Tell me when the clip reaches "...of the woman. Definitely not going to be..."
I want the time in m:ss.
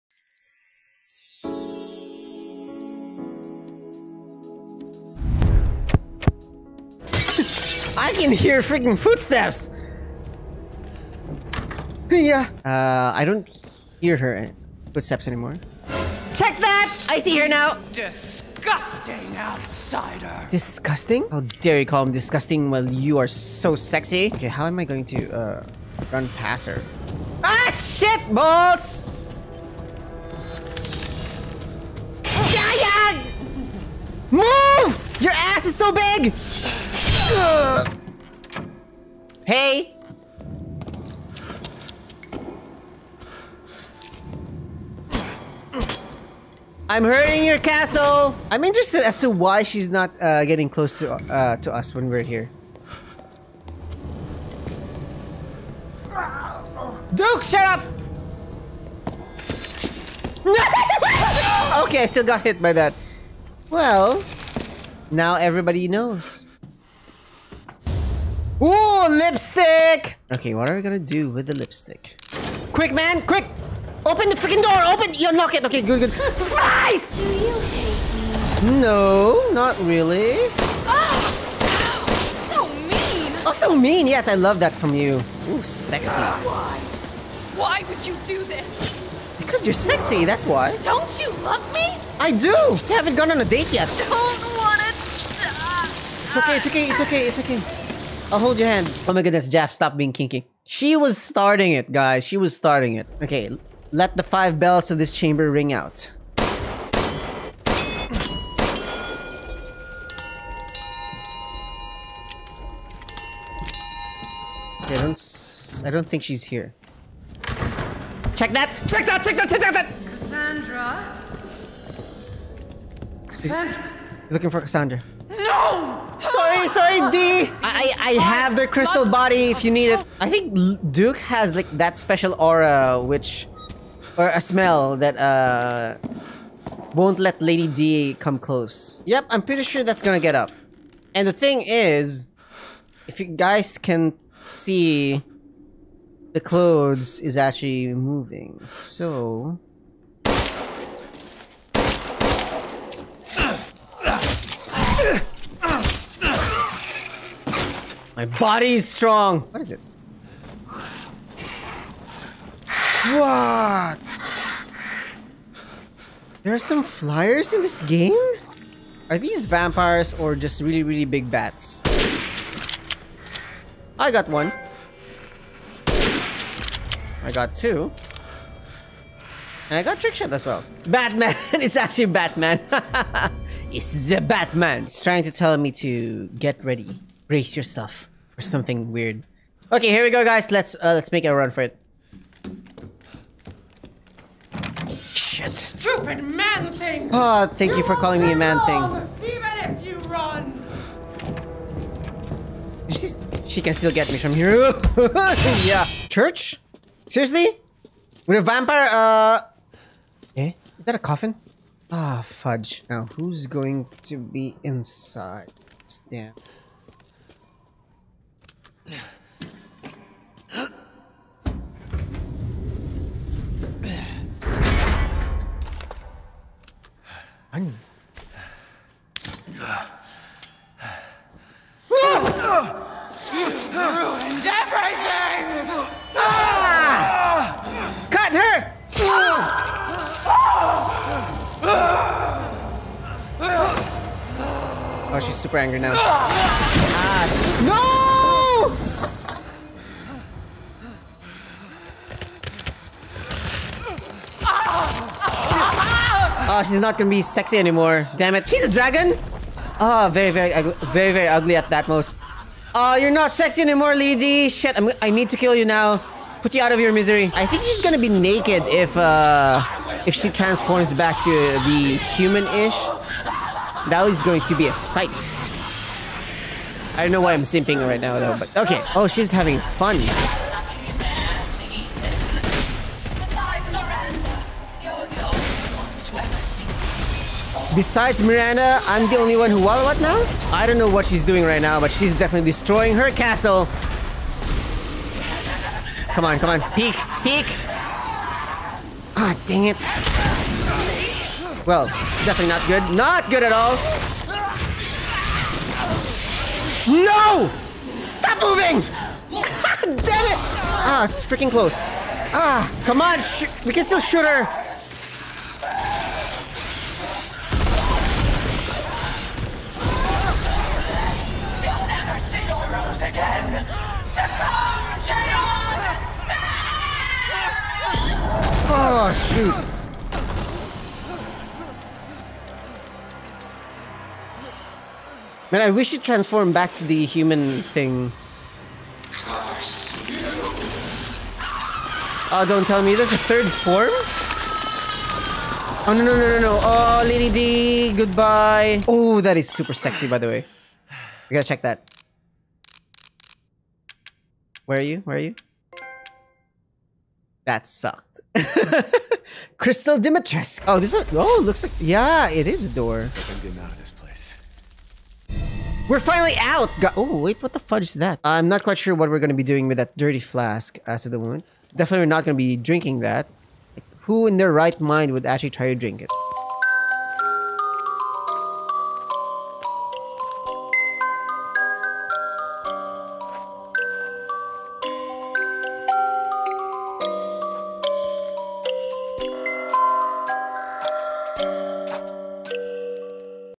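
6:11.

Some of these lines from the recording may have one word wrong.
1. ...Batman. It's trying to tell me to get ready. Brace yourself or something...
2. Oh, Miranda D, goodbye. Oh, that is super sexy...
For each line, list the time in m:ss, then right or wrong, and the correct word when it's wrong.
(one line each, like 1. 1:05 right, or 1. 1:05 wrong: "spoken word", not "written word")
1. 3:04 right
2. 5:46 wrong: "Lady", not "Miranda".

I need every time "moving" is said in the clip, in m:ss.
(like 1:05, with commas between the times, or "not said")
2:27, 5:08.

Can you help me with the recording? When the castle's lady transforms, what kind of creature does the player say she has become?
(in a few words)
Dragon.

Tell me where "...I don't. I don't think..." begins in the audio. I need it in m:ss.
1:54.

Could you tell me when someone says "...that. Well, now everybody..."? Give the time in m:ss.
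1:02.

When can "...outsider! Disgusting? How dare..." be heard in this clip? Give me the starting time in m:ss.
0:19.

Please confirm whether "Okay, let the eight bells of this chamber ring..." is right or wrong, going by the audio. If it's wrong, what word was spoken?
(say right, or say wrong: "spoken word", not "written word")
wrong: "five", not "eight".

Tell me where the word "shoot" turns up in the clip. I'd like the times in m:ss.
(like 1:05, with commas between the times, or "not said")
5:14, 5:29.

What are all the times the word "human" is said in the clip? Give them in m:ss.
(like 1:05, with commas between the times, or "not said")
4:32, 5:37.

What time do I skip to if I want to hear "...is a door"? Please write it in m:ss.
6:02.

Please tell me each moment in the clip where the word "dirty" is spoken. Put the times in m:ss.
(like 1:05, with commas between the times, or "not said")
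6:09.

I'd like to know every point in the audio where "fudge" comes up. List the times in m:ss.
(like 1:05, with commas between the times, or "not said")
3:32, 6:07.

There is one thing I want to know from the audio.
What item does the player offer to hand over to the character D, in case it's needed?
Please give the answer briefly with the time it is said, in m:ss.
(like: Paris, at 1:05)
Crystal body, at 2:08.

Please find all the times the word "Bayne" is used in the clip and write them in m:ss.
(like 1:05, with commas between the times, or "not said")
not said.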